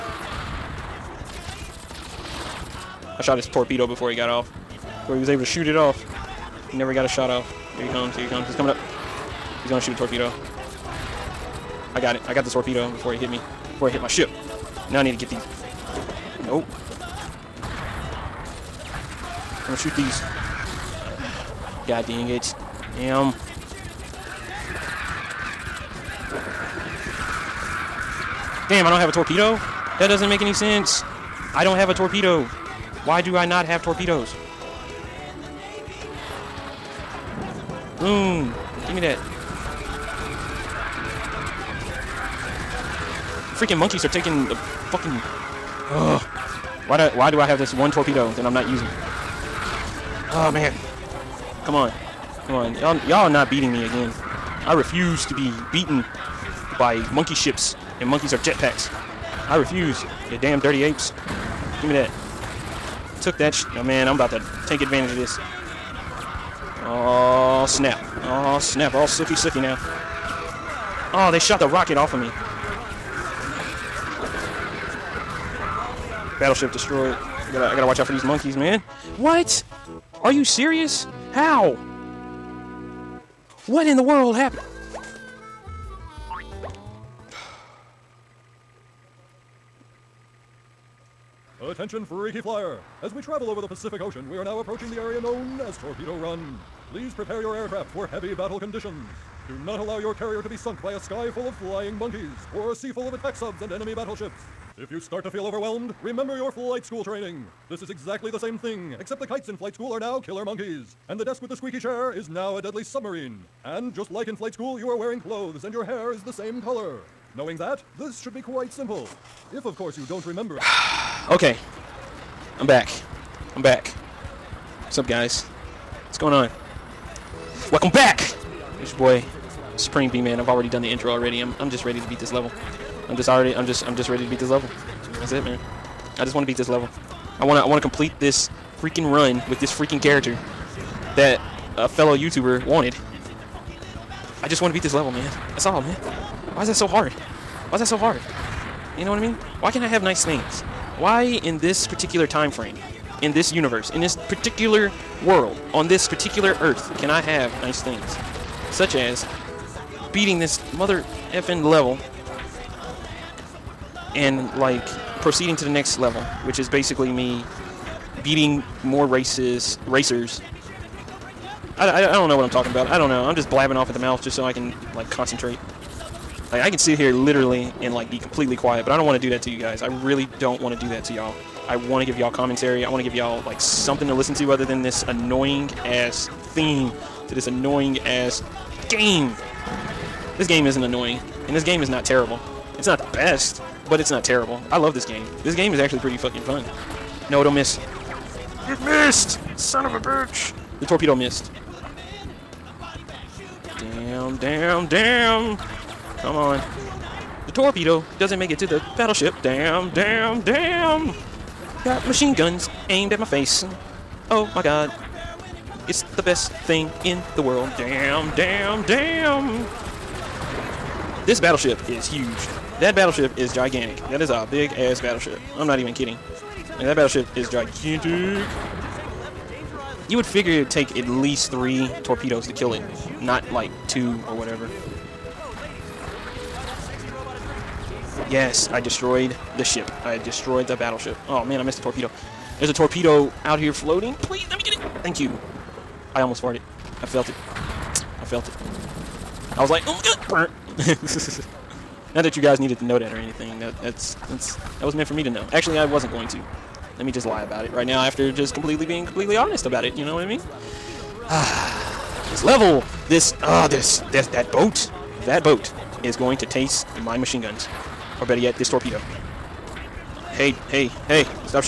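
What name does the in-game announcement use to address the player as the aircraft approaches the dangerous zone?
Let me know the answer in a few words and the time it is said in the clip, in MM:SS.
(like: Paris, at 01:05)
Freaky Flyer, at 01:32.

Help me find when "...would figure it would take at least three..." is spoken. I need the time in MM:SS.
03:50.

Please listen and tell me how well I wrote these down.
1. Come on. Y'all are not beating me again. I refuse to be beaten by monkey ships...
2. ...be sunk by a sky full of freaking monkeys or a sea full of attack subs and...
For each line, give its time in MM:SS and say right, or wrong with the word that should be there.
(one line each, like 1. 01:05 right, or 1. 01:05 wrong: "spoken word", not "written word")
1. 00:52 right
2. 01:40 wrong: "flying", not "freaking".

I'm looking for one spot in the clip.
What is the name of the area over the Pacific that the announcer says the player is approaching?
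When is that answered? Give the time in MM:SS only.
01:35.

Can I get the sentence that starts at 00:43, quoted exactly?
Freaking monkeys are taking the fucking...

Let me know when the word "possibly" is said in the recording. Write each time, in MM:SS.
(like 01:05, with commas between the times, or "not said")
not said.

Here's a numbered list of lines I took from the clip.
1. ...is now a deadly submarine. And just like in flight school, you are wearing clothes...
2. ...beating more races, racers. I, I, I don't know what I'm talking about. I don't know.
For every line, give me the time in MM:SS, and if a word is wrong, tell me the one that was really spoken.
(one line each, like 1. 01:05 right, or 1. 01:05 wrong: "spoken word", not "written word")
1. 01:52 right
2. 02:48 right.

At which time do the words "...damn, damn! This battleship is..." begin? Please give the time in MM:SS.
03:38.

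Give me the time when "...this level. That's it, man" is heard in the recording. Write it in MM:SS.
02:14.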